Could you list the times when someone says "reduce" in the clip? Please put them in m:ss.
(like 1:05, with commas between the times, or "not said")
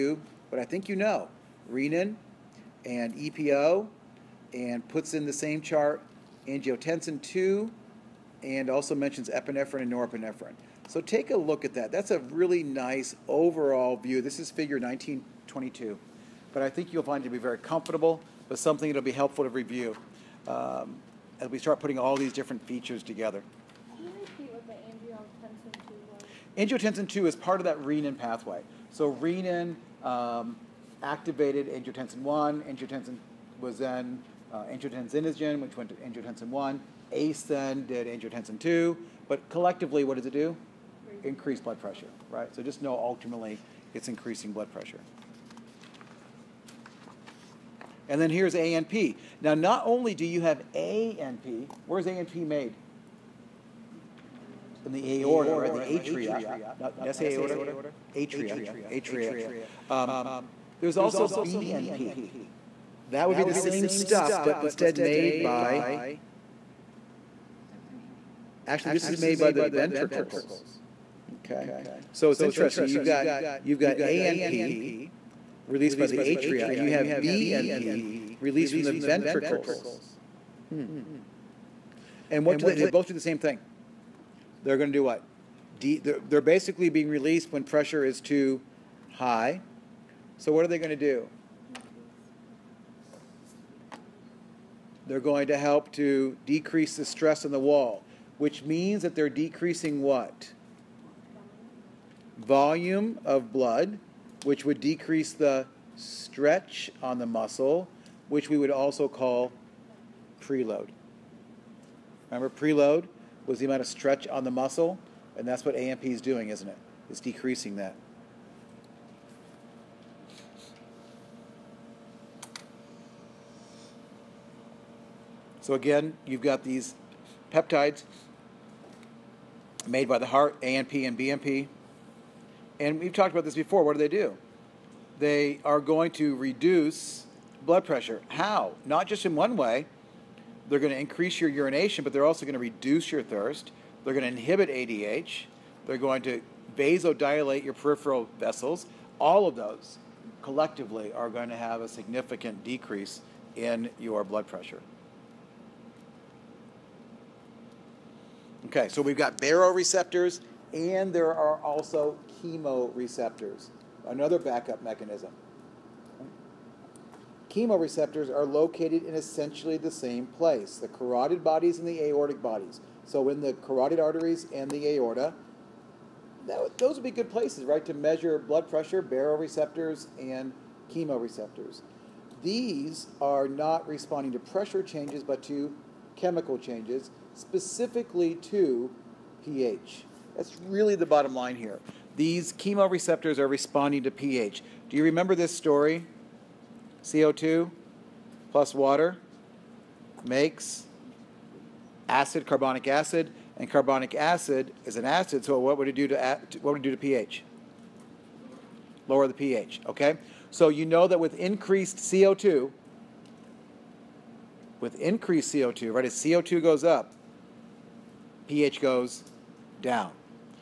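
2:16, 2:22.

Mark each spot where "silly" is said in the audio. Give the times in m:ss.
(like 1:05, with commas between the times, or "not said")
not said.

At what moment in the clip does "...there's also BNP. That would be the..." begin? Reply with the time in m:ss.
1:00.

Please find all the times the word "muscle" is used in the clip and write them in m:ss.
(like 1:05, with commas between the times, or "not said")
1:47, 1:54.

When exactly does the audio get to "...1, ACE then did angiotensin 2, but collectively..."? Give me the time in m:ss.
0:36.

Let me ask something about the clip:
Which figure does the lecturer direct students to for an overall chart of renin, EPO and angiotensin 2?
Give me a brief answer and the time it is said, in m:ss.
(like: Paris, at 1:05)
Figure 1922, at 0:14.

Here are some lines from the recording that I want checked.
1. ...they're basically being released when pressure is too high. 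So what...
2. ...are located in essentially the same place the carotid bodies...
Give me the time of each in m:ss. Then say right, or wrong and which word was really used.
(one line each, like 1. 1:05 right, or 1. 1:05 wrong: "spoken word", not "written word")
1. 1:26 right
2. 2:48 right.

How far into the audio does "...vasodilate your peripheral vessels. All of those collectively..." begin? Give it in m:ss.
2:26.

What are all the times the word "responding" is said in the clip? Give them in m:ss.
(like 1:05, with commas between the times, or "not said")
3:03, 3:13.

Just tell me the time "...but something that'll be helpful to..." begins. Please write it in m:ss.
0:18.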